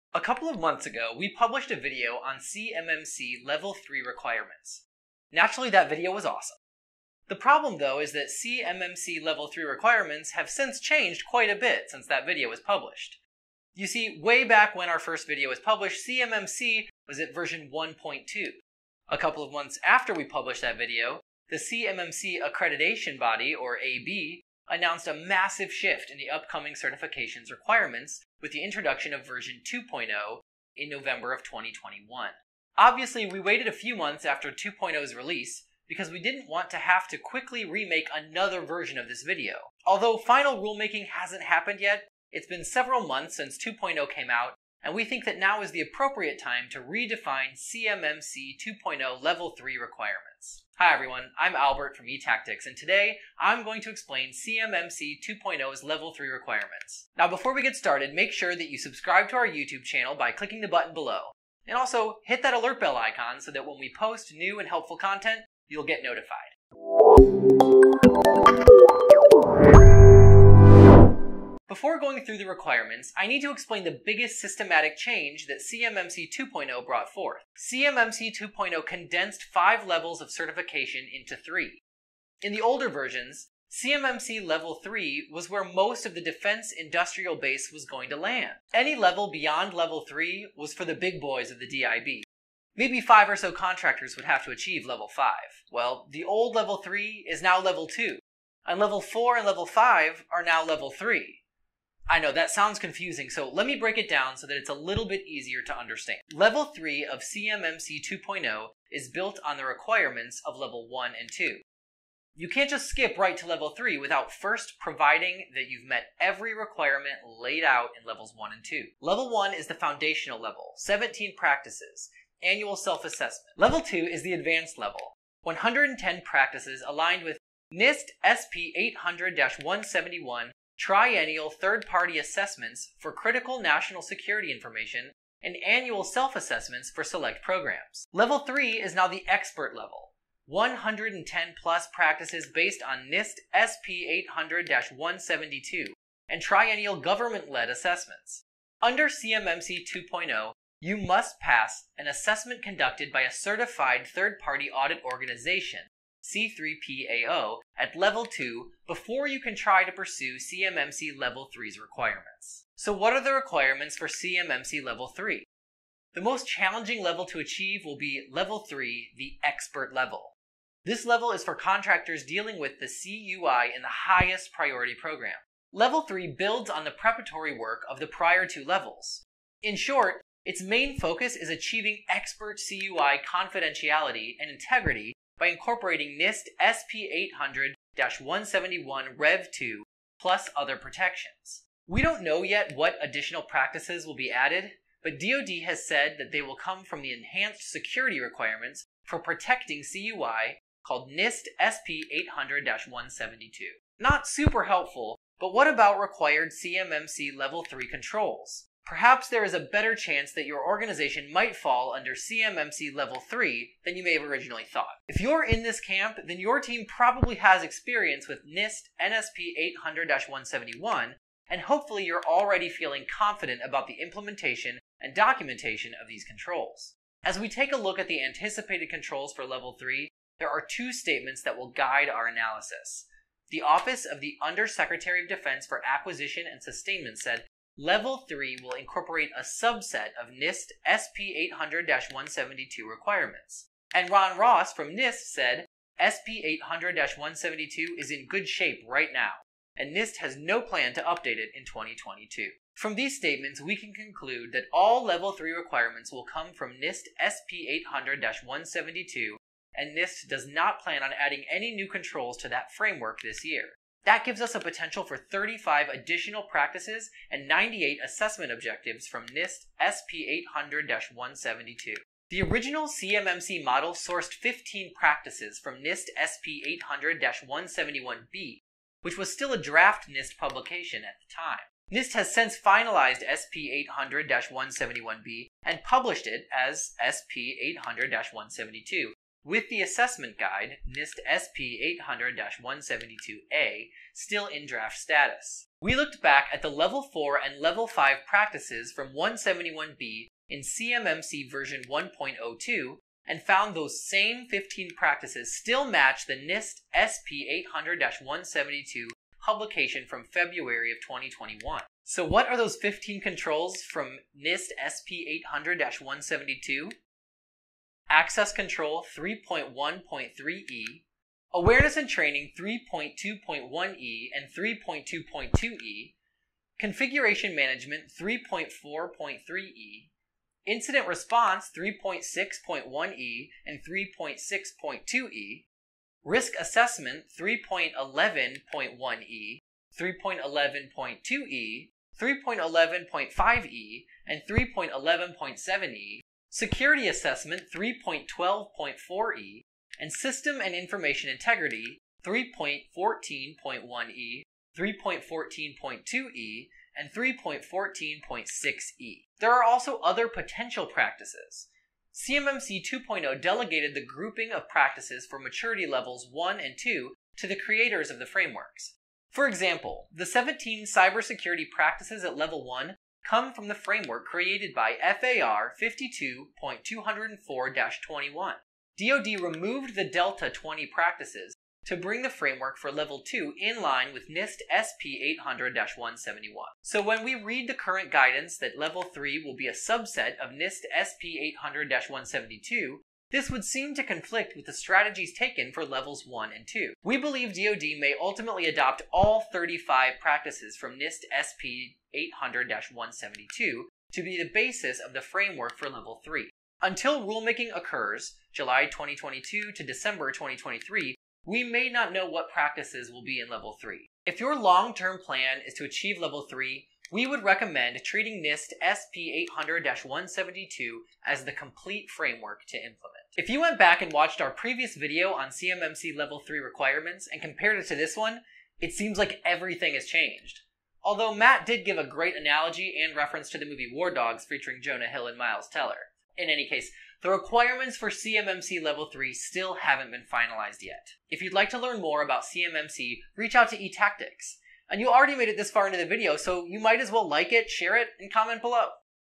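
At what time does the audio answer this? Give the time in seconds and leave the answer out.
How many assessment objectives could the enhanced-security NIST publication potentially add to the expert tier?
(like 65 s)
267 s.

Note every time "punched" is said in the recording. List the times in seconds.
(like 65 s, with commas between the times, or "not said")
not said.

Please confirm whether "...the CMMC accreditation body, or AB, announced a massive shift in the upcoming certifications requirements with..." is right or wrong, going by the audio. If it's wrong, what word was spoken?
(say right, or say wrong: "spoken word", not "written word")
right.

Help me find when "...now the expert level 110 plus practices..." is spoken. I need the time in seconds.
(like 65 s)
138 s.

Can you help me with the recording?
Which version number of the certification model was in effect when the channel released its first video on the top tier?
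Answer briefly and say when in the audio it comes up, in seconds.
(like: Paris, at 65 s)
1.2, at 17 s.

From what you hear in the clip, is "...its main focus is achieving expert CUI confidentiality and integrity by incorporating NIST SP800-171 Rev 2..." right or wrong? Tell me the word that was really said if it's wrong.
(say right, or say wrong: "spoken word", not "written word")
right.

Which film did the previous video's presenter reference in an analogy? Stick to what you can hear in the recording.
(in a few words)
War Dogs.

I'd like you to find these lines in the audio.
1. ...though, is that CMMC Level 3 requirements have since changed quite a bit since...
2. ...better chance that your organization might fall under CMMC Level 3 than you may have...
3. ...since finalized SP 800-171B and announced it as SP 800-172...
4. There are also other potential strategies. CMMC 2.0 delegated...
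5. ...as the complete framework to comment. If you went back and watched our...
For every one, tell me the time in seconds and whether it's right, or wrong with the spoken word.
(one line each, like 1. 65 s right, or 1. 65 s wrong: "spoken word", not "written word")
1. 7 s right
2. 209 s right
3. 282 s wrong: "published", not "announced"
4. 359 s wrong: "practices", not "strategies"
5. 421 s wrong: "implement", not "comment".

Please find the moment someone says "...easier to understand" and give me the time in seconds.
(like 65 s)
105 s.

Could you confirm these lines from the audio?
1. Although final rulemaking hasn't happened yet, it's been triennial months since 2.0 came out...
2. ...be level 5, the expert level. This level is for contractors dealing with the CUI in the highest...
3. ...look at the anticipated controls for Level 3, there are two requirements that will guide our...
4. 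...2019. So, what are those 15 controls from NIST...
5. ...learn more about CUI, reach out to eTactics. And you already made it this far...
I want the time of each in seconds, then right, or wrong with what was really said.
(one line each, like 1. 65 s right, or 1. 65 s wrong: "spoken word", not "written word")
1. 39 s wrong: "several", not "triennial"
2. 167 s wrong: "3", not "5"
3. 227 s wrong: "statements", not "requirements"
4. 311 s wrong: "2021", not "2019"
5. 441 s wrong: "CMMC", not "CUI".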